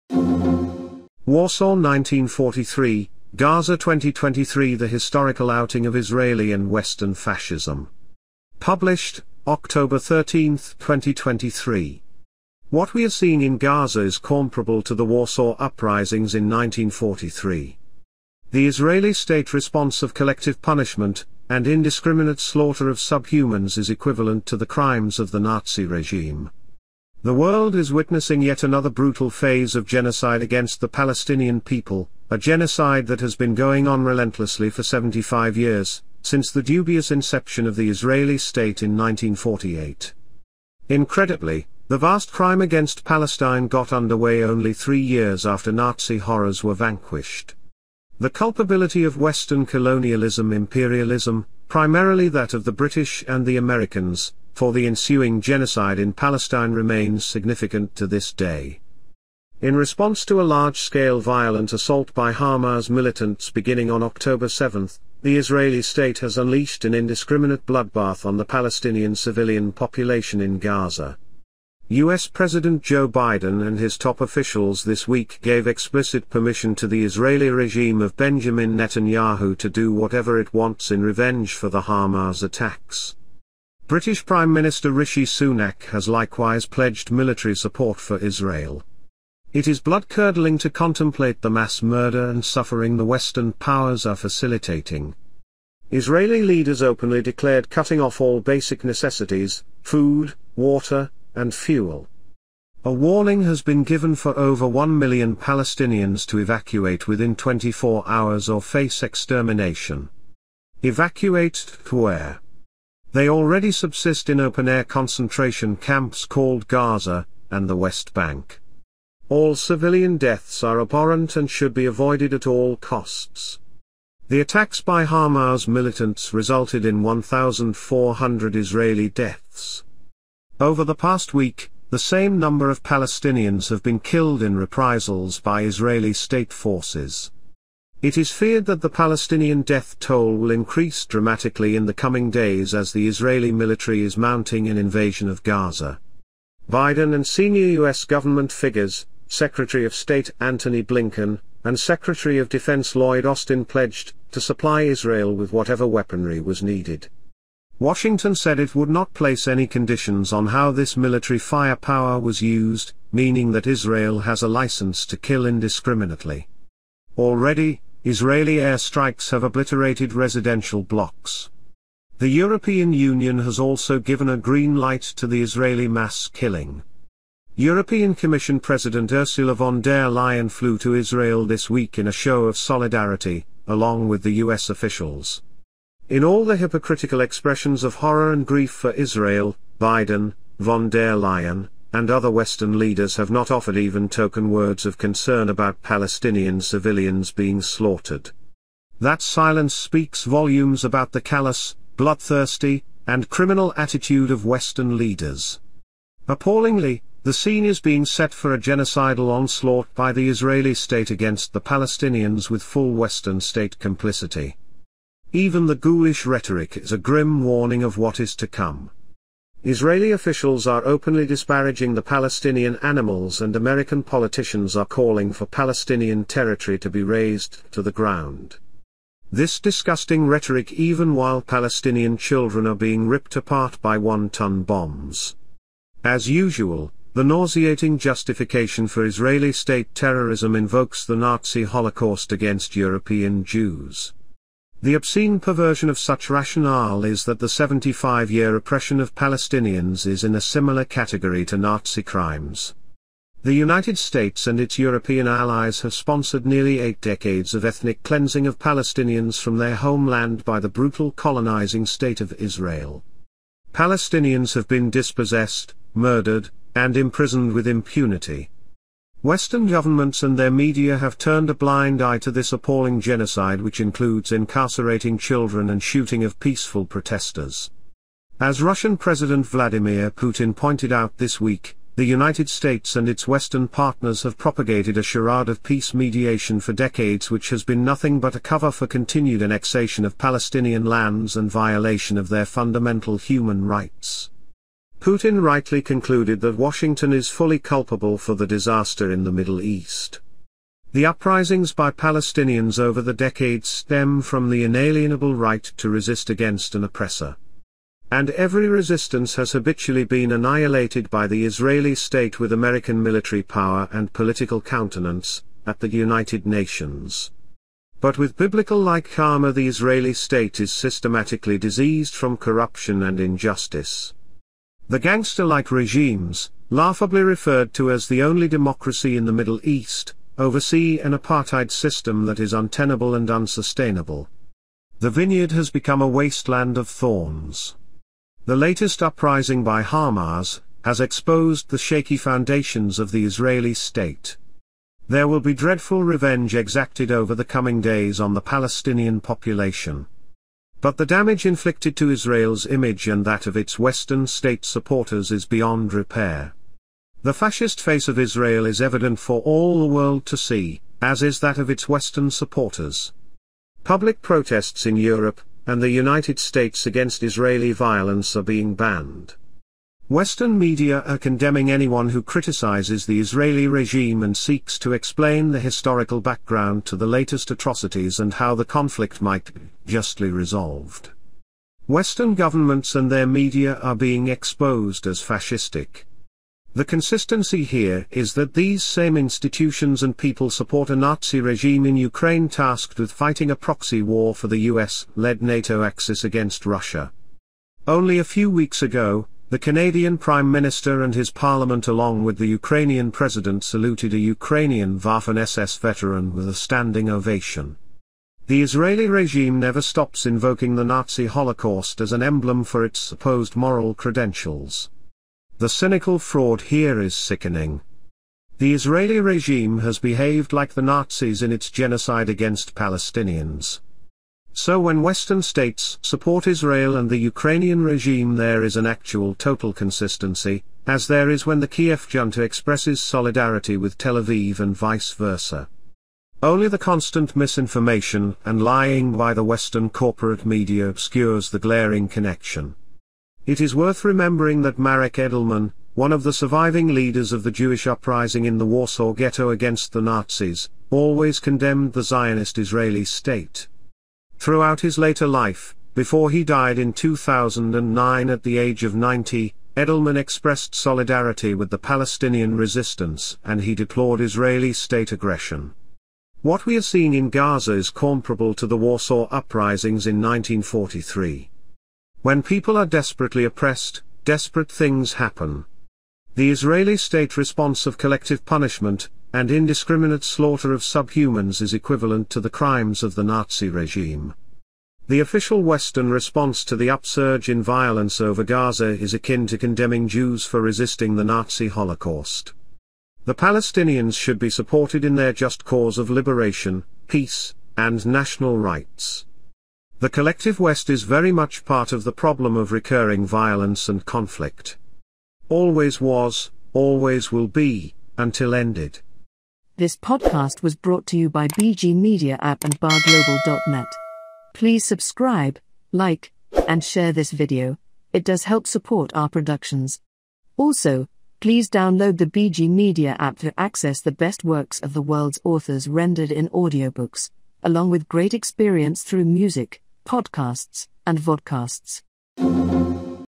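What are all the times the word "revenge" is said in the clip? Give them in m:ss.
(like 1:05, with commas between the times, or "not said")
1:21, 5:46.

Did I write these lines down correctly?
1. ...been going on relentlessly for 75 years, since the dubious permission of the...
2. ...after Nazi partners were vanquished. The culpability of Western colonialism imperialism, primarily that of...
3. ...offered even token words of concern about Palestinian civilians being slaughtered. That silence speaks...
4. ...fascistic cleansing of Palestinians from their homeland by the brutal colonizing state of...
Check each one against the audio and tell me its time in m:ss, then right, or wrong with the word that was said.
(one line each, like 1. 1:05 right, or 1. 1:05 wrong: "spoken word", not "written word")
1. 0:33 wrong: "inception", not "permission"
2. 0:45 wrong: "horrors", not "partners"
3. 3:13 right
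4. 4:17 wrong: "ethnic", not "fascistic".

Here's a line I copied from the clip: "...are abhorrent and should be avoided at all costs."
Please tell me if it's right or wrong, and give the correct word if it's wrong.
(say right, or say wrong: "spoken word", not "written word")
right.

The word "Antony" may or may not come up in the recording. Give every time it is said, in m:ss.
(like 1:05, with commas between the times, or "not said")
2:30.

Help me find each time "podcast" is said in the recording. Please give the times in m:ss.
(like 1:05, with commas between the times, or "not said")
8:29, 8:50.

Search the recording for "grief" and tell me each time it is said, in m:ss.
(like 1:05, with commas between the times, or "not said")
3:08.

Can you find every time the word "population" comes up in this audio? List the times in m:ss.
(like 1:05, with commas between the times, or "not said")
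1:09, 5:49.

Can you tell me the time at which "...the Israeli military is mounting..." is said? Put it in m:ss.
2:22.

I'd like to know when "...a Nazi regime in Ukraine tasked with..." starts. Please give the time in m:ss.
6:30.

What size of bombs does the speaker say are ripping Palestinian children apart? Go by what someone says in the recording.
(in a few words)
One-ton bombs.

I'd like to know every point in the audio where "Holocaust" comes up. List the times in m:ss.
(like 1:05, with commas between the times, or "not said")
4:01, 6:51, 8:11.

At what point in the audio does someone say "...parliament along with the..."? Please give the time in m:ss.
6:41.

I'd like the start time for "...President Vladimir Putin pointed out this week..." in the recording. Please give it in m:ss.
4:38.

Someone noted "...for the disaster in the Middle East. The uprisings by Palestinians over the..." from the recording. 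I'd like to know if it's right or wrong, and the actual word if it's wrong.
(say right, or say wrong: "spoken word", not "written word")
right.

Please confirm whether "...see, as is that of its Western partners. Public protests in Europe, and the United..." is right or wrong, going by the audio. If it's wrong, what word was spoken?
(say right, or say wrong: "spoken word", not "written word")
wrong: "supporters", not "partners".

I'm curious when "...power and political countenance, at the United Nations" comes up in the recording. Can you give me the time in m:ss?
5:13.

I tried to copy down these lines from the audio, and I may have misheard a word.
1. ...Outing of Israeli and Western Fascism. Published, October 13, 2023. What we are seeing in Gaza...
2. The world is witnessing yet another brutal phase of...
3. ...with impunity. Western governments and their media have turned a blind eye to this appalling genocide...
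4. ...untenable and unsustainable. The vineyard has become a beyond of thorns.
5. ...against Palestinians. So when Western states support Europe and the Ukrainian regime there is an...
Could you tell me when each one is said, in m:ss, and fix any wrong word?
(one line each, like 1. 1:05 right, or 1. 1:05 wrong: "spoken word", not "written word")
1. 0:05 right
2. 0:27 right
3. 4:27 right
4. 5:32 wrong: "wasteland", not "beyond"
5. 7:02 wrong: "Israel", not "Europe".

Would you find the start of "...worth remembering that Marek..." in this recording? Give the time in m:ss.
7:23.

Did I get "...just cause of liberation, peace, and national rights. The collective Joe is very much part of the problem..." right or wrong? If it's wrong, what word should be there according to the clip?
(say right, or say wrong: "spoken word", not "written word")
wrong: "West", not "Joe".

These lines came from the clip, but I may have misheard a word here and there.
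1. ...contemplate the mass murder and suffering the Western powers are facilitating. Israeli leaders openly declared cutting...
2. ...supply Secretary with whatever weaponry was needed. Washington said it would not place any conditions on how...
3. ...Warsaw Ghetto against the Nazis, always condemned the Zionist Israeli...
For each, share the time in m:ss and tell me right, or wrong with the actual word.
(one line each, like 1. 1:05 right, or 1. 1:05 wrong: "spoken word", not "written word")
1. 1:30 right
2. 2:34 wrong: "Israel", not "Secretary"
3. 7:28 right.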